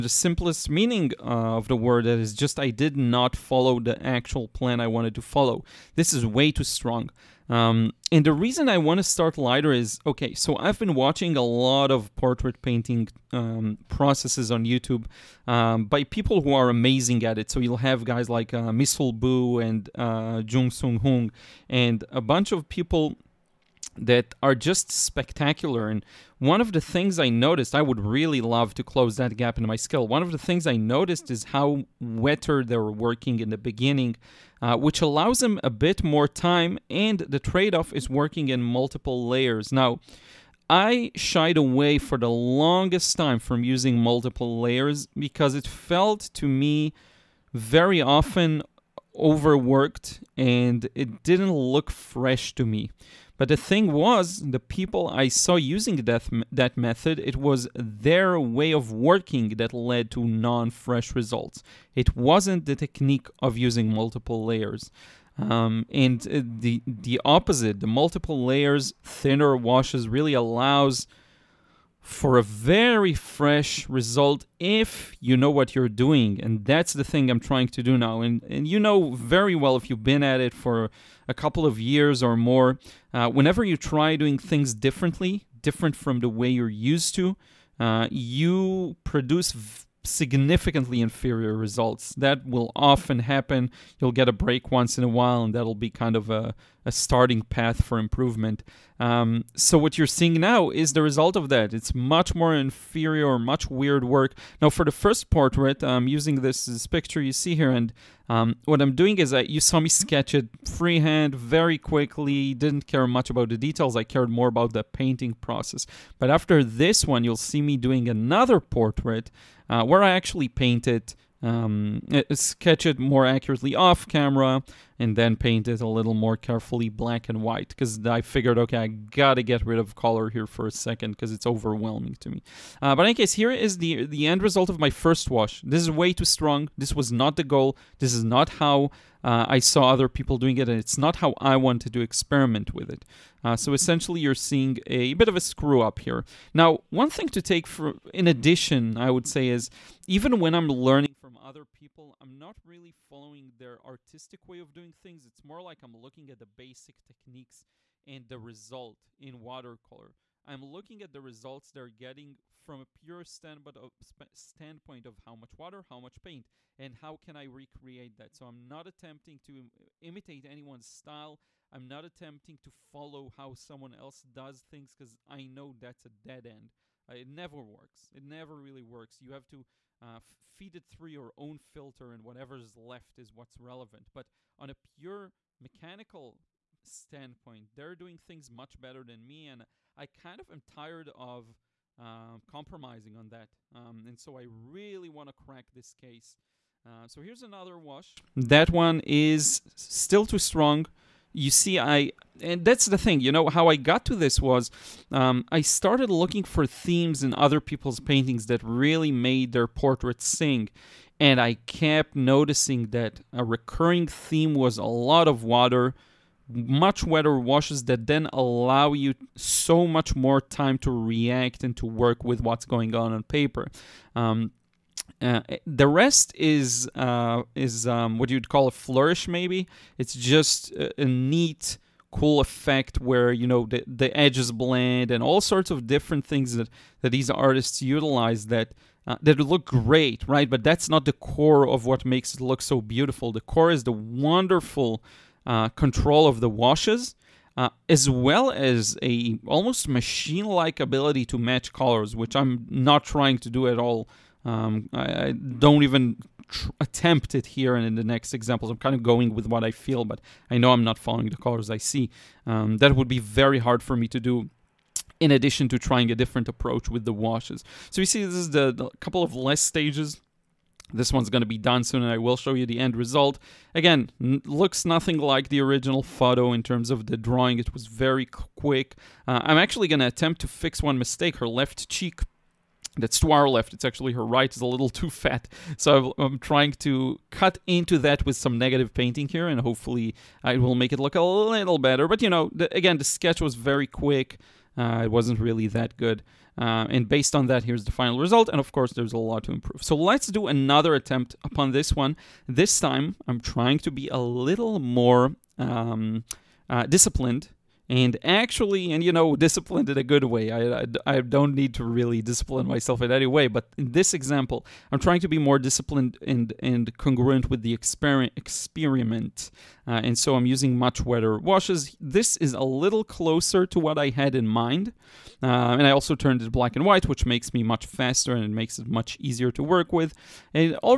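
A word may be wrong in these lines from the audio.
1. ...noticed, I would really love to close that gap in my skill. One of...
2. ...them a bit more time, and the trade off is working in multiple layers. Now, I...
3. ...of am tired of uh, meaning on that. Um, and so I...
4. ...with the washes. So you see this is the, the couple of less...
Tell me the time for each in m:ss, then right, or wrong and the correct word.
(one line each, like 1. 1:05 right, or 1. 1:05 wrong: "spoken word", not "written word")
1. 0:27 right
2. 0:35 right
3. 3:10 wrong: "compromising", not "meaning"
4. 4:26 right.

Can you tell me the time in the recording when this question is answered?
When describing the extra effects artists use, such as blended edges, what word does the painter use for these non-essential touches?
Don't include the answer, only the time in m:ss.
3:48.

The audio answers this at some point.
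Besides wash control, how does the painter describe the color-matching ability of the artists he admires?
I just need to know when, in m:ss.
4:09.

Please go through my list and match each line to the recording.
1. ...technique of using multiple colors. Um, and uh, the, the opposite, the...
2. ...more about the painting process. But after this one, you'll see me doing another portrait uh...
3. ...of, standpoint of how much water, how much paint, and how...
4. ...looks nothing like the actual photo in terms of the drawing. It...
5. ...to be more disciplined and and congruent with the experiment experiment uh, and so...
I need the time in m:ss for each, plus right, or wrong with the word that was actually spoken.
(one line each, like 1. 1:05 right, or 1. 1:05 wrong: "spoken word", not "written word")
1. 1:02 wrong: "layers", not "colors"
2. 1:54 right
3. 2:43 right
4. 4:34 wrong: "original", not "actual"
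5. 5:15 right.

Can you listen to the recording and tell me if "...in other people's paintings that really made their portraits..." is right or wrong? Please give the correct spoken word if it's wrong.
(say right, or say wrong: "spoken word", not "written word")
right.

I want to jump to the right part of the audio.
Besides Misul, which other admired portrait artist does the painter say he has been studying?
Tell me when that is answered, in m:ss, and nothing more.
0:20.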